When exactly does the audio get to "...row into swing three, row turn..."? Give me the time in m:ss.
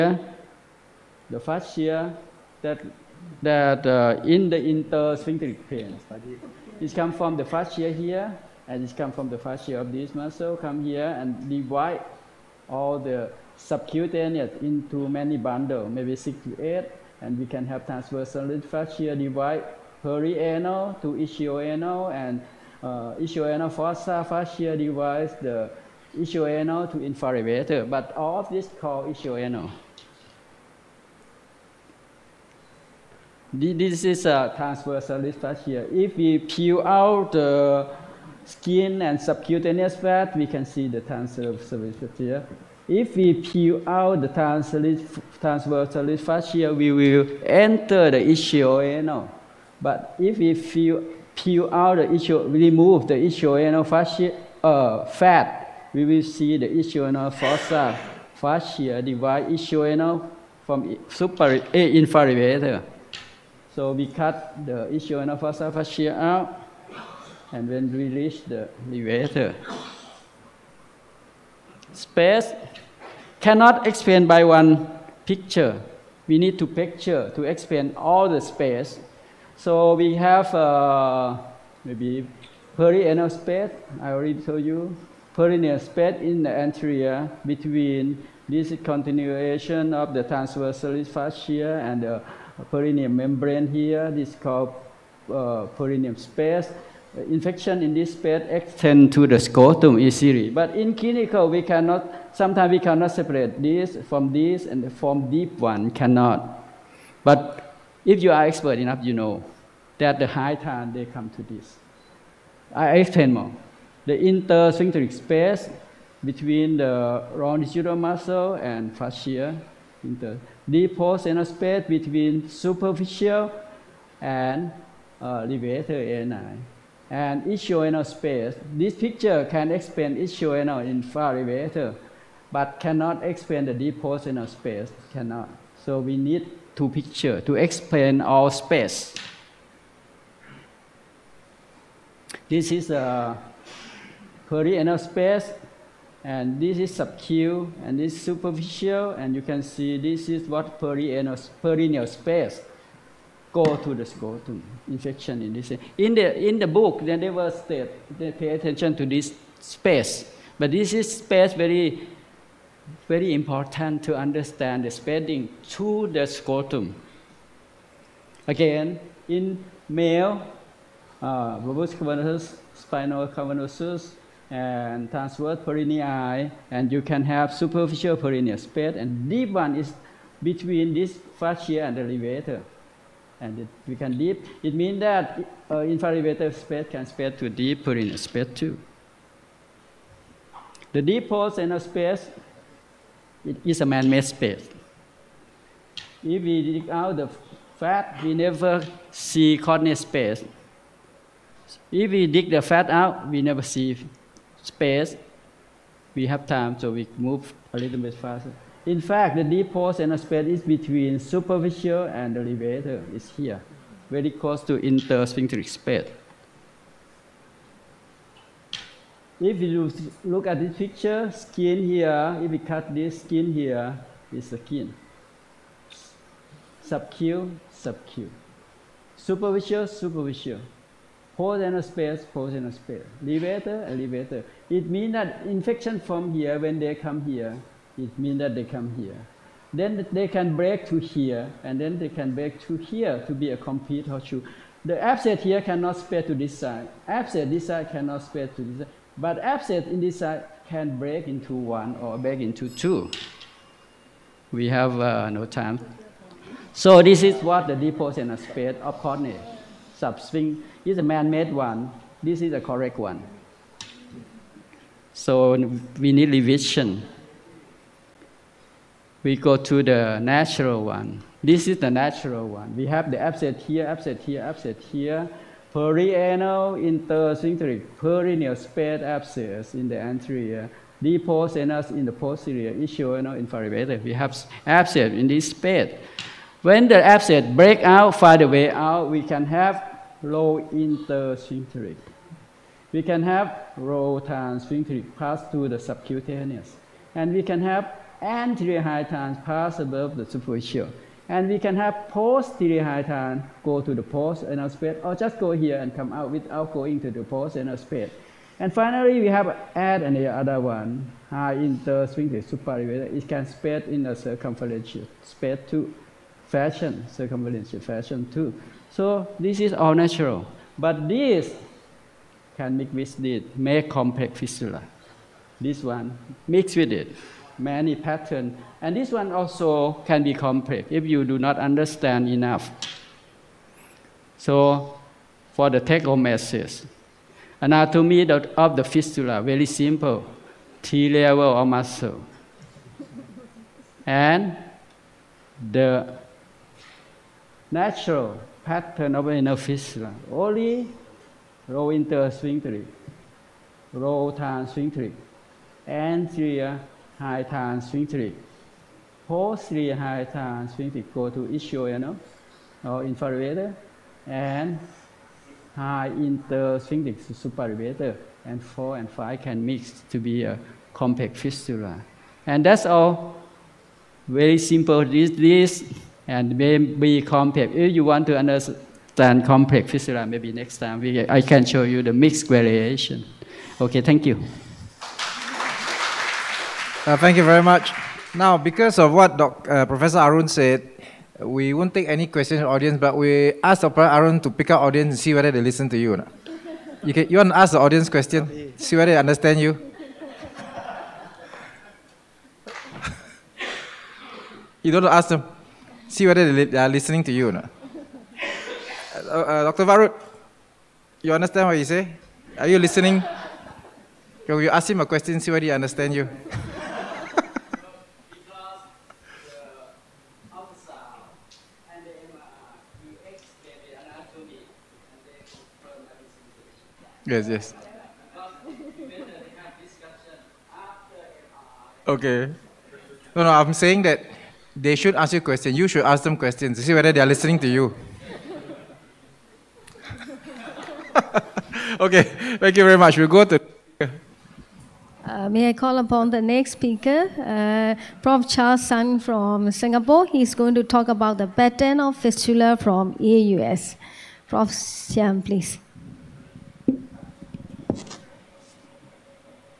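5:51.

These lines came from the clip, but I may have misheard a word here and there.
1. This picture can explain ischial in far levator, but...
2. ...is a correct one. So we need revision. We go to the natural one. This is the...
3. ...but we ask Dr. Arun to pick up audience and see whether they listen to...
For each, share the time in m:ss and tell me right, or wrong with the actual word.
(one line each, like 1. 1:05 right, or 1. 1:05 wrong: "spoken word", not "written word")
1. 2:08 right
2. 4:22 right
3. 6:33 right.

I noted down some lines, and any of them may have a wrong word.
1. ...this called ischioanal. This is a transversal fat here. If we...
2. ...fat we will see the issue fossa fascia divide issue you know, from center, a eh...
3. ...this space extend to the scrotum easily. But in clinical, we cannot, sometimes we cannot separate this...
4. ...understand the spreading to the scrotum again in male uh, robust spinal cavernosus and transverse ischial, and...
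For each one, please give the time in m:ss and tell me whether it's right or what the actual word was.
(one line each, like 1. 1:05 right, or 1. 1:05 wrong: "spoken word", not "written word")
1. 0:28 right
2. 0:55 wrong: "super", not "center"
3. 1:37 right
4. 2:44 wrong: "perineal", not "ischial".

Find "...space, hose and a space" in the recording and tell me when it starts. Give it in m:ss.
3:51.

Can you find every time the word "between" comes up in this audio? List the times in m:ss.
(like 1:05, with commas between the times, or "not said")
1:27, 1:56, 2:01, 3:00, 3:30.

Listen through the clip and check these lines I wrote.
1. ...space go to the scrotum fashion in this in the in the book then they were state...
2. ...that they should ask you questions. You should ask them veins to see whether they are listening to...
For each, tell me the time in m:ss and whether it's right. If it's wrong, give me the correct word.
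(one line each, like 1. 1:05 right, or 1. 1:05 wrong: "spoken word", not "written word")
1. 2:32 wrong: "infection", not "fashion"
2. 7:14 wrong: "questions", not "veins".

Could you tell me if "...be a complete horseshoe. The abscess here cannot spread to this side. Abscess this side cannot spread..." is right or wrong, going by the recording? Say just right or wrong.
right.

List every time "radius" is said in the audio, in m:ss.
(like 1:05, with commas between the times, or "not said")
not said.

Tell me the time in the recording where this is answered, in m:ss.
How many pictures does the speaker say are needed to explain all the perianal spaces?
2:16.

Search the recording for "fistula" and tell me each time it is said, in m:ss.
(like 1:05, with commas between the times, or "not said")
5:24, 5:38, 6:11, 6:19, 7:32.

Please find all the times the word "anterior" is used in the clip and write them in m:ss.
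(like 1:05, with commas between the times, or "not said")
1:26, 4:40, 4:58.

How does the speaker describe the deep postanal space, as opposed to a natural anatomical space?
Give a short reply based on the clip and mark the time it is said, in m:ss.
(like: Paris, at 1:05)
Man-made space, at 3:13.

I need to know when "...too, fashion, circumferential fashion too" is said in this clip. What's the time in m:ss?
5:15.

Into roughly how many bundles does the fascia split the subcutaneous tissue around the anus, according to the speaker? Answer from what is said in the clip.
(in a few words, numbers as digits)
6 to 8.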